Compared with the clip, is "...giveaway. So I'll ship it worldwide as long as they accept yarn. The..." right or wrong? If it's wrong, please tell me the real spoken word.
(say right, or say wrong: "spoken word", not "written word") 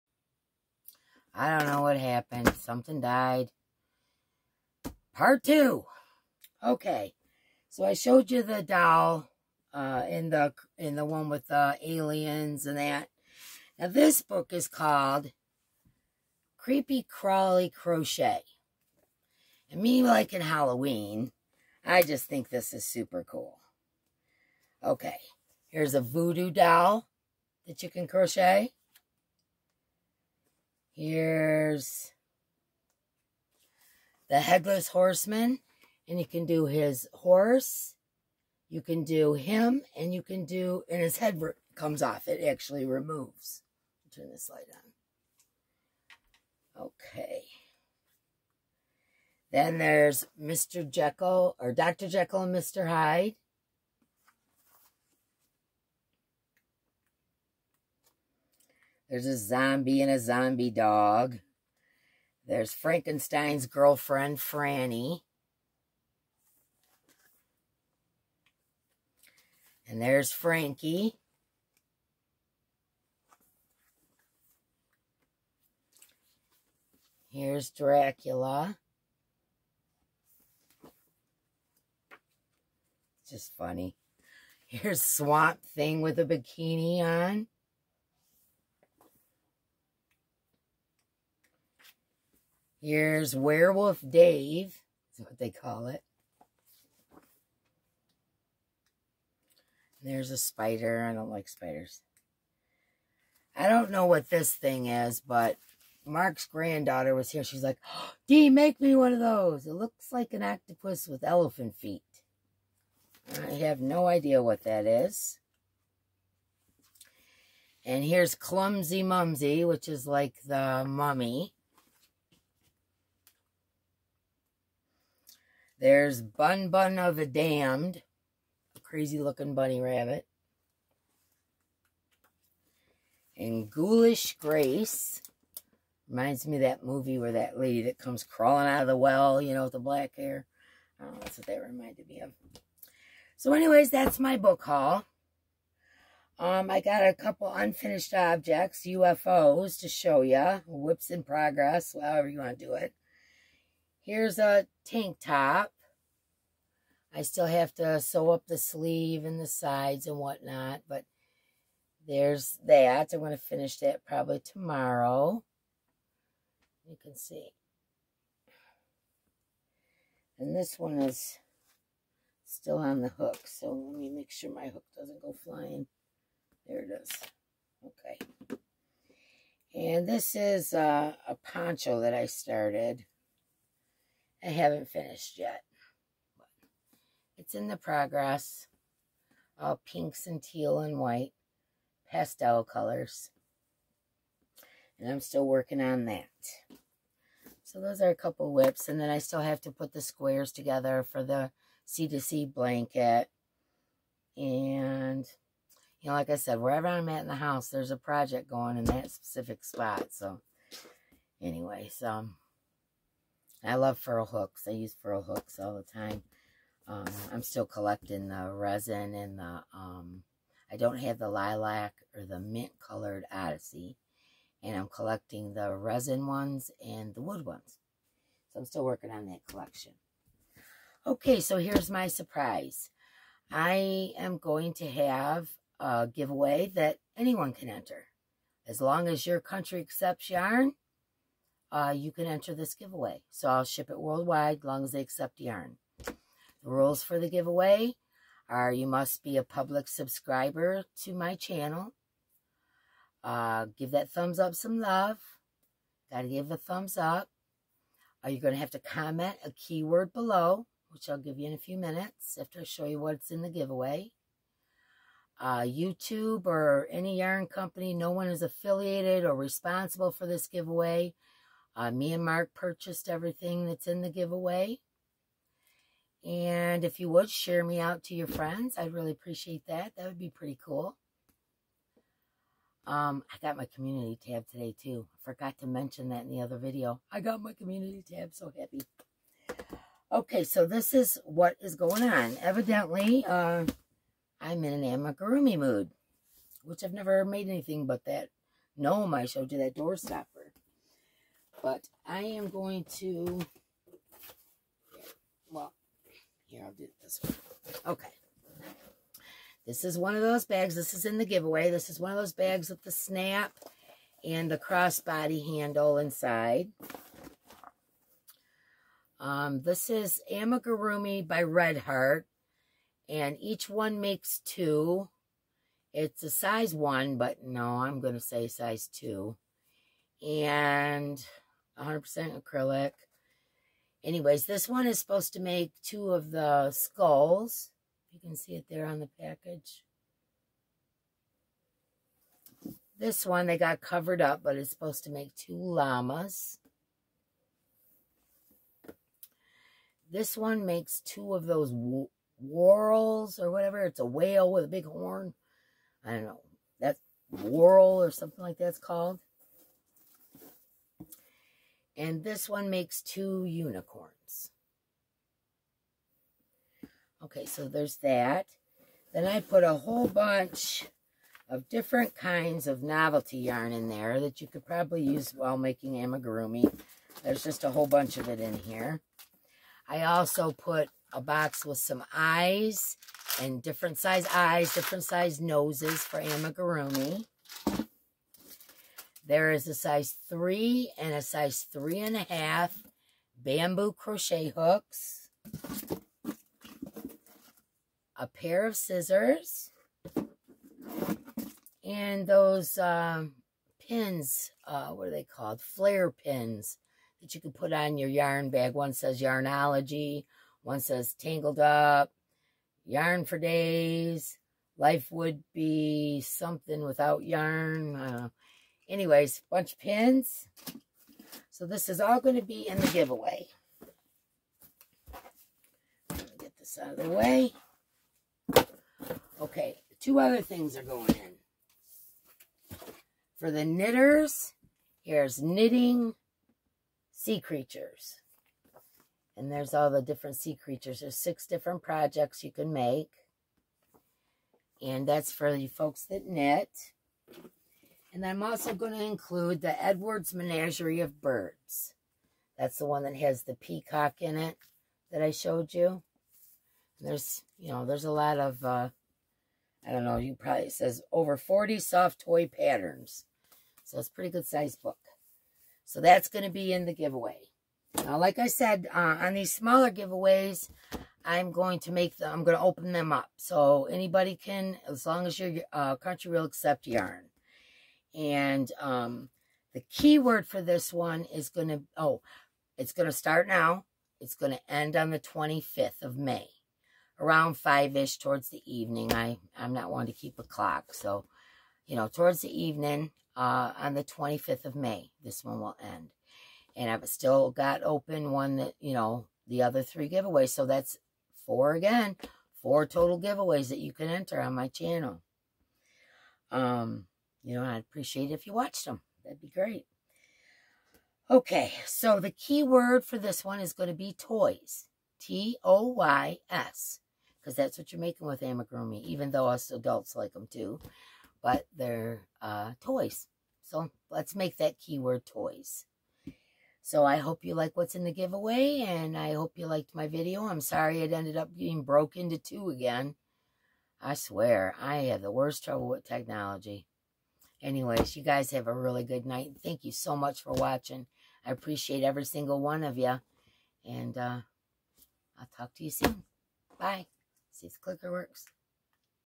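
right.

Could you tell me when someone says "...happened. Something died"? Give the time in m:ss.
0:01.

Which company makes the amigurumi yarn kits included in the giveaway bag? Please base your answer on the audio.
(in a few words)
Red Heart.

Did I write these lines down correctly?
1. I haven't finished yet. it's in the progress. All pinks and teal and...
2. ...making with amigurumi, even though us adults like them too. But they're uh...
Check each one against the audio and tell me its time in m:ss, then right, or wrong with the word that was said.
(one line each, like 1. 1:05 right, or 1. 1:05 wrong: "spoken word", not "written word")
1. 3:04 right
2. 8:38 right.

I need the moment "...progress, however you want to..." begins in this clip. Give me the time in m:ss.
2:31.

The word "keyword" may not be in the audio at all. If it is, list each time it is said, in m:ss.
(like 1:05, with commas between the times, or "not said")
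4:19, 8:44.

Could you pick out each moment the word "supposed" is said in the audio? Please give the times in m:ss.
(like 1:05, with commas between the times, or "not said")
5:34, 5:44.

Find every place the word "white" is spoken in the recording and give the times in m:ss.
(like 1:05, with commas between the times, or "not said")
3:10.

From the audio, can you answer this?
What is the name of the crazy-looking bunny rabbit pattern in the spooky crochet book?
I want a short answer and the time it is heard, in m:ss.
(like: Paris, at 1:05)
Bun Bun of the Damned, at 2:06.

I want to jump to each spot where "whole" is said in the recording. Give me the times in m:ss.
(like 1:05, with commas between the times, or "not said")
6:09, 6:17.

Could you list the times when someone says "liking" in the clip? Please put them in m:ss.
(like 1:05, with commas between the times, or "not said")
0:20.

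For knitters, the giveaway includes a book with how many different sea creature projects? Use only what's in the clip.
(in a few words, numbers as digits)
6.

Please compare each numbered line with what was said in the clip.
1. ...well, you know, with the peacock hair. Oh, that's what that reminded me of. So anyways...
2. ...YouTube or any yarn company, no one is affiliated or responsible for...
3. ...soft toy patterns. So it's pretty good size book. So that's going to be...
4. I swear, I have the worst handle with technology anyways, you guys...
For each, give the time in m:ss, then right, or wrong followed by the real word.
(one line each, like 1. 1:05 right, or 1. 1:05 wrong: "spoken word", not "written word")
1. 2:18 wrong: "black", not "peacock"
2. 4:25 right
3. 7:41 right
4. 8:54 wrong: "trouble", not "handle".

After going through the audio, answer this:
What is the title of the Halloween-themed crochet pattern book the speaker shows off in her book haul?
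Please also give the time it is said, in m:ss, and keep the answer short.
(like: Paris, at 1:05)
Creepy Crawly Crochet, at 0:16.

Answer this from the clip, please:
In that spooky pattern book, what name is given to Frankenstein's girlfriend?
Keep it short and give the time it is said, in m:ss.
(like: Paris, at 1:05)
Franny, at 1:04.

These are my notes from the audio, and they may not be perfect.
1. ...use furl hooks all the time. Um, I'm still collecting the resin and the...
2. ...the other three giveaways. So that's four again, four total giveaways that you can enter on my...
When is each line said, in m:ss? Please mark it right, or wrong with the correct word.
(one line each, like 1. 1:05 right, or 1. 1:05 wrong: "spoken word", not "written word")
1. 3:34 right
2. 8:19 right.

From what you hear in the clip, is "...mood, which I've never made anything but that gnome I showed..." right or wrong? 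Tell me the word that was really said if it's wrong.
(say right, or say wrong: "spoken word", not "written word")
right.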